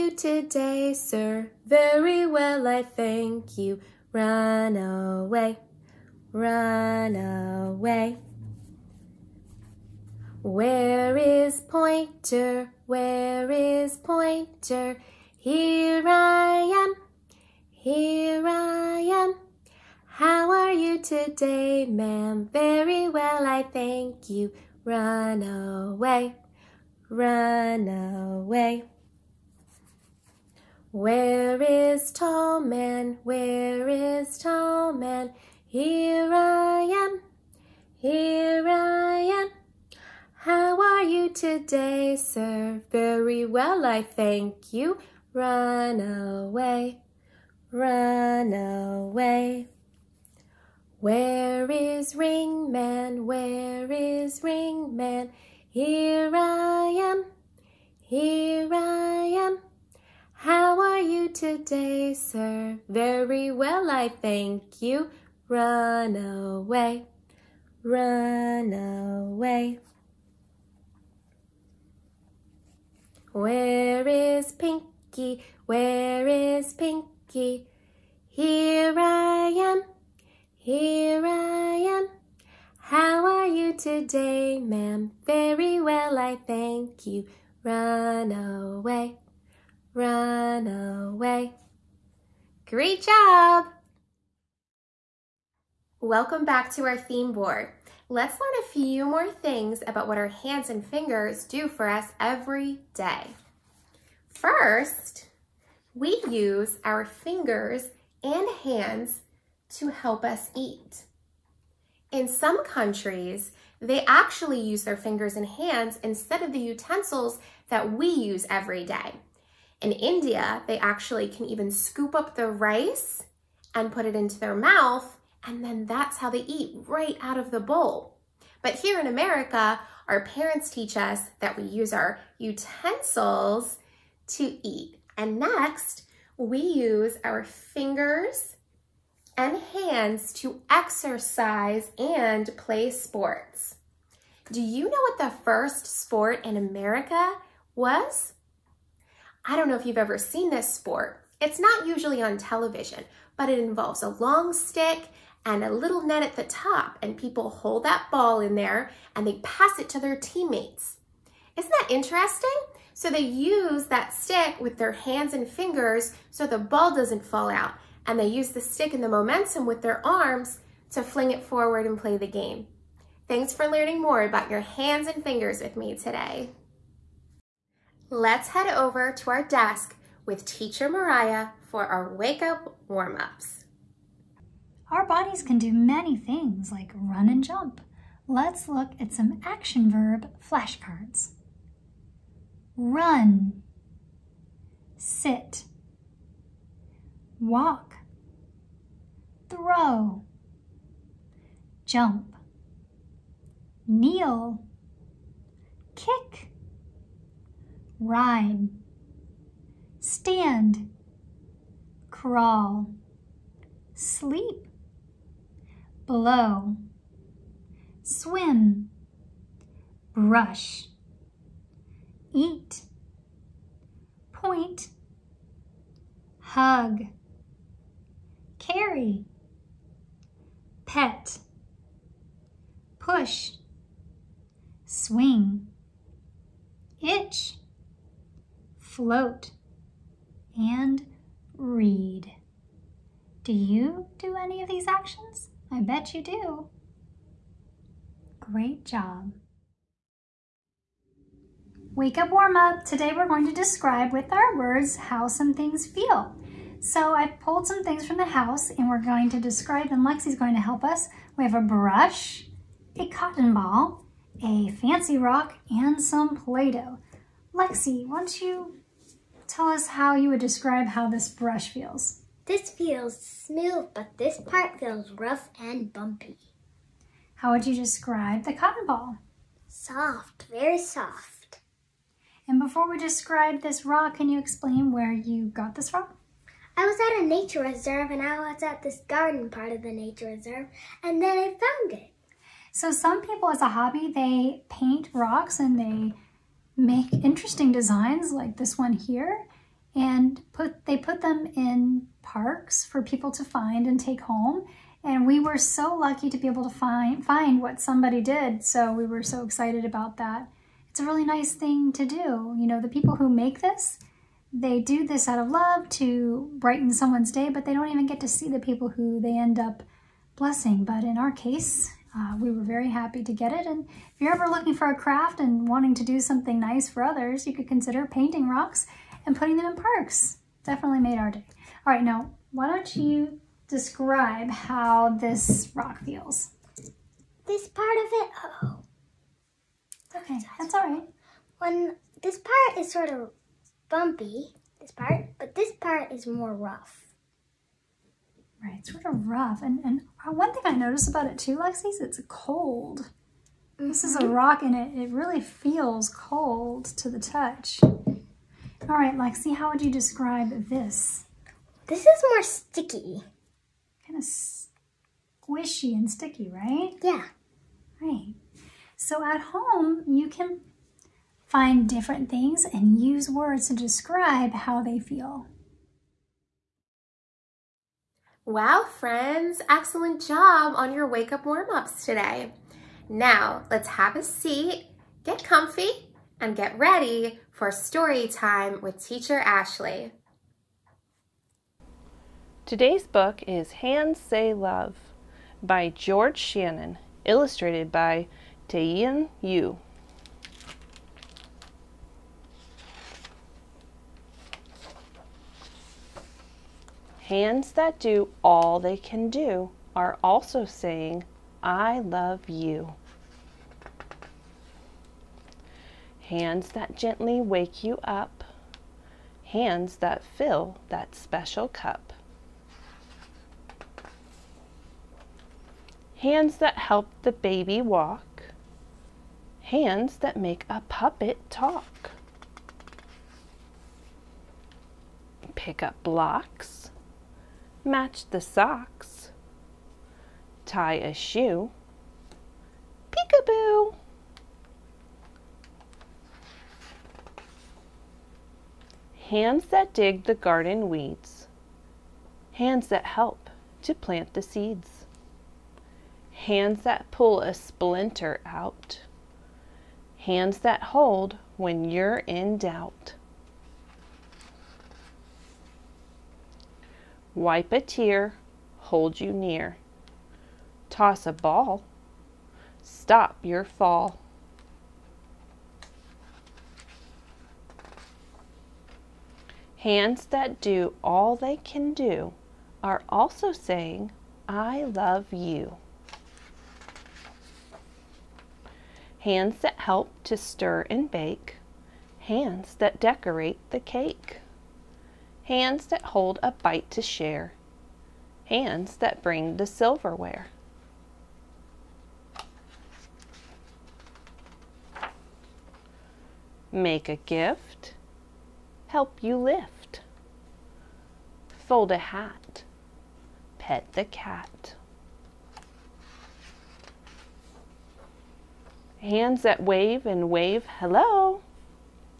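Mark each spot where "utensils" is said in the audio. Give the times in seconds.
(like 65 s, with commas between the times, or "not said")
116 s, 132 s.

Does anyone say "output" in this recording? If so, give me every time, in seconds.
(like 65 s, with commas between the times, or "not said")
not said.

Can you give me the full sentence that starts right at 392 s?
Today's book is Hands Say Love by George Shannon, illustrated by Taeeun Yoo.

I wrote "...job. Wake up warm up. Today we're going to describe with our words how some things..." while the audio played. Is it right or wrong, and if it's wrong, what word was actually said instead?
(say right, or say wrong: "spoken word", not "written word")
right.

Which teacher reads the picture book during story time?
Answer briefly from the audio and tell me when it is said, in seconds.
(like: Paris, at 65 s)
Teacher Ashley, at 389 s.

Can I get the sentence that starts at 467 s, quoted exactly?
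wipe a tear, hold you near.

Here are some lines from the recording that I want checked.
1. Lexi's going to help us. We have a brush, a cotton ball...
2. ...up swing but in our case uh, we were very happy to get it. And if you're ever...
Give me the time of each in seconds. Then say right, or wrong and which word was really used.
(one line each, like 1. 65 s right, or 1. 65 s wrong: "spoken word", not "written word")
1. 260 s right
2. 319 s wrong: "blessing", not "swing".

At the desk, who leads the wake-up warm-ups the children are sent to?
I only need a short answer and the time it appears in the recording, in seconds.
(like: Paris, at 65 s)
Teacher Mariah, at 180 s.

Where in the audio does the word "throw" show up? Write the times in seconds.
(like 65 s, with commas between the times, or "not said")
199 s.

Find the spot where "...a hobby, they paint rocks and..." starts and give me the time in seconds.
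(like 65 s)
293 s.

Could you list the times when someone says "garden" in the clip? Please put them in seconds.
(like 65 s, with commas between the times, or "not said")
289 s, 450 s.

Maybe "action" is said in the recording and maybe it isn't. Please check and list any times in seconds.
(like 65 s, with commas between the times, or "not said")
189 s, 244 s.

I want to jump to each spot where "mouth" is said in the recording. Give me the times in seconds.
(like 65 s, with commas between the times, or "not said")
124 s.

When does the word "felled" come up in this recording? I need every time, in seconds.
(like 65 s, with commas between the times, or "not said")
not said.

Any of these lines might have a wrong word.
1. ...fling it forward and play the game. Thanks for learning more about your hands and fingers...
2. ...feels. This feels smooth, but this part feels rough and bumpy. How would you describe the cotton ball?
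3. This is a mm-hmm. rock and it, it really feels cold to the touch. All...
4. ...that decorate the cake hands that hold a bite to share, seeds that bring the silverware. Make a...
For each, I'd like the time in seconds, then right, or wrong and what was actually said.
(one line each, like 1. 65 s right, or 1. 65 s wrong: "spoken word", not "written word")
1. 171 s right
2. 271 s right
3. 353 s right
4. 492 s wrong: "hands", not "seeds".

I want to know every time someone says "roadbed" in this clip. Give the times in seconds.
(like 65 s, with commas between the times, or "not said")
not said.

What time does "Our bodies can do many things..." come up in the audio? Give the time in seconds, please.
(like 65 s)
184 s.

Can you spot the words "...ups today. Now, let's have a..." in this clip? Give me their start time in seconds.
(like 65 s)
381 s.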